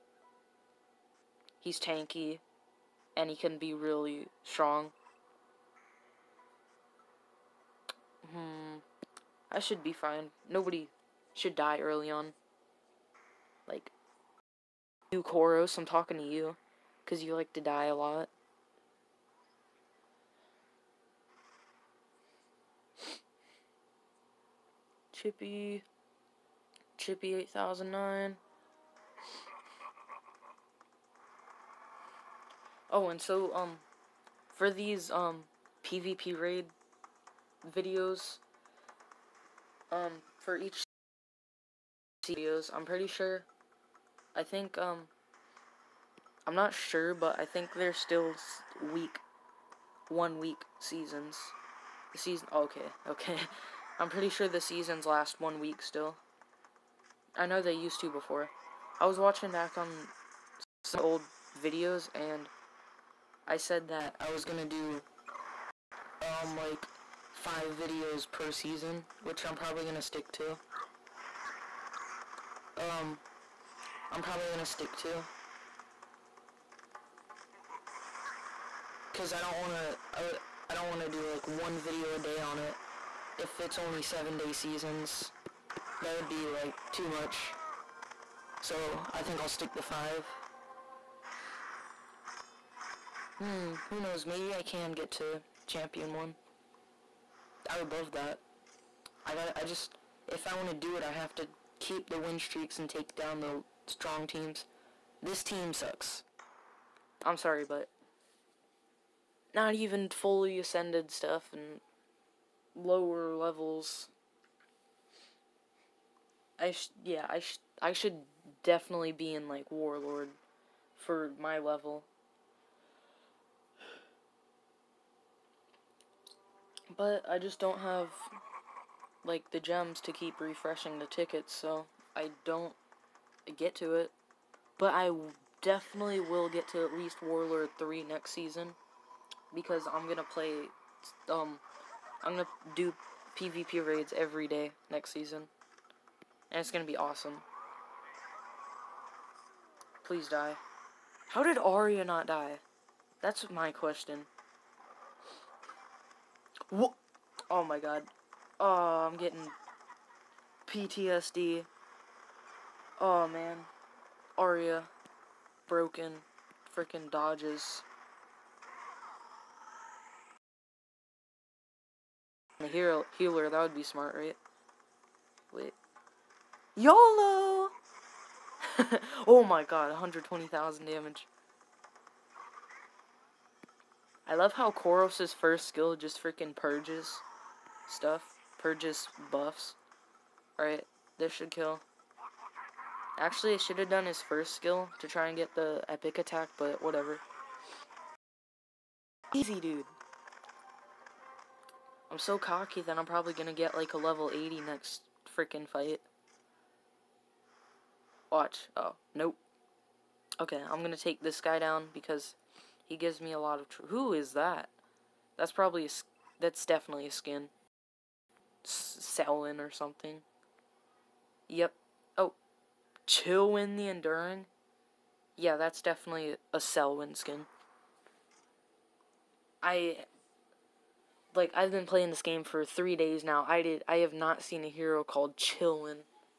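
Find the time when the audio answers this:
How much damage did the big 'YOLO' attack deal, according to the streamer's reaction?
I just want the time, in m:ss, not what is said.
2:59.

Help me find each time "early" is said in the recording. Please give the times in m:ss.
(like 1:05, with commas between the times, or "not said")
0:11.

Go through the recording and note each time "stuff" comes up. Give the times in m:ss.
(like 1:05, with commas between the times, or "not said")
1:51, 3:07.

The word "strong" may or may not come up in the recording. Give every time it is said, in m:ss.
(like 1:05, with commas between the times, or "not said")
0:04, 1:43.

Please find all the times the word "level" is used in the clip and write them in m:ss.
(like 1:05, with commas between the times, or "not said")
1:53, 2:01, 3:23.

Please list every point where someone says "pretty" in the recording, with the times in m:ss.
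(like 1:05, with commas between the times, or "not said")
0:42, 0:54.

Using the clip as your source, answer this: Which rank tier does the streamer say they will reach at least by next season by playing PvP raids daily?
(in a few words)
Warlord 3.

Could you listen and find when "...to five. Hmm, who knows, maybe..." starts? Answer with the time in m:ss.
1:29.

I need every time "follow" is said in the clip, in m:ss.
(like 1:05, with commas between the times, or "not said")
not said.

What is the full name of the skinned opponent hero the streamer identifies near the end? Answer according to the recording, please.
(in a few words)
Chillin the Enduring.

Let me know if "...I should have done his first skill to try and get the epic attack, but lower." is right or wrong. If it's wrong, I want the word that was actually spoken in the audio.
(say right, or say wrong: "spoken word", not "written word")
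wrong: "whatever", not "lower".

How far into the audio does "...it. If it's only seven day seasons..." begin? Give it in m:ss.
1:22.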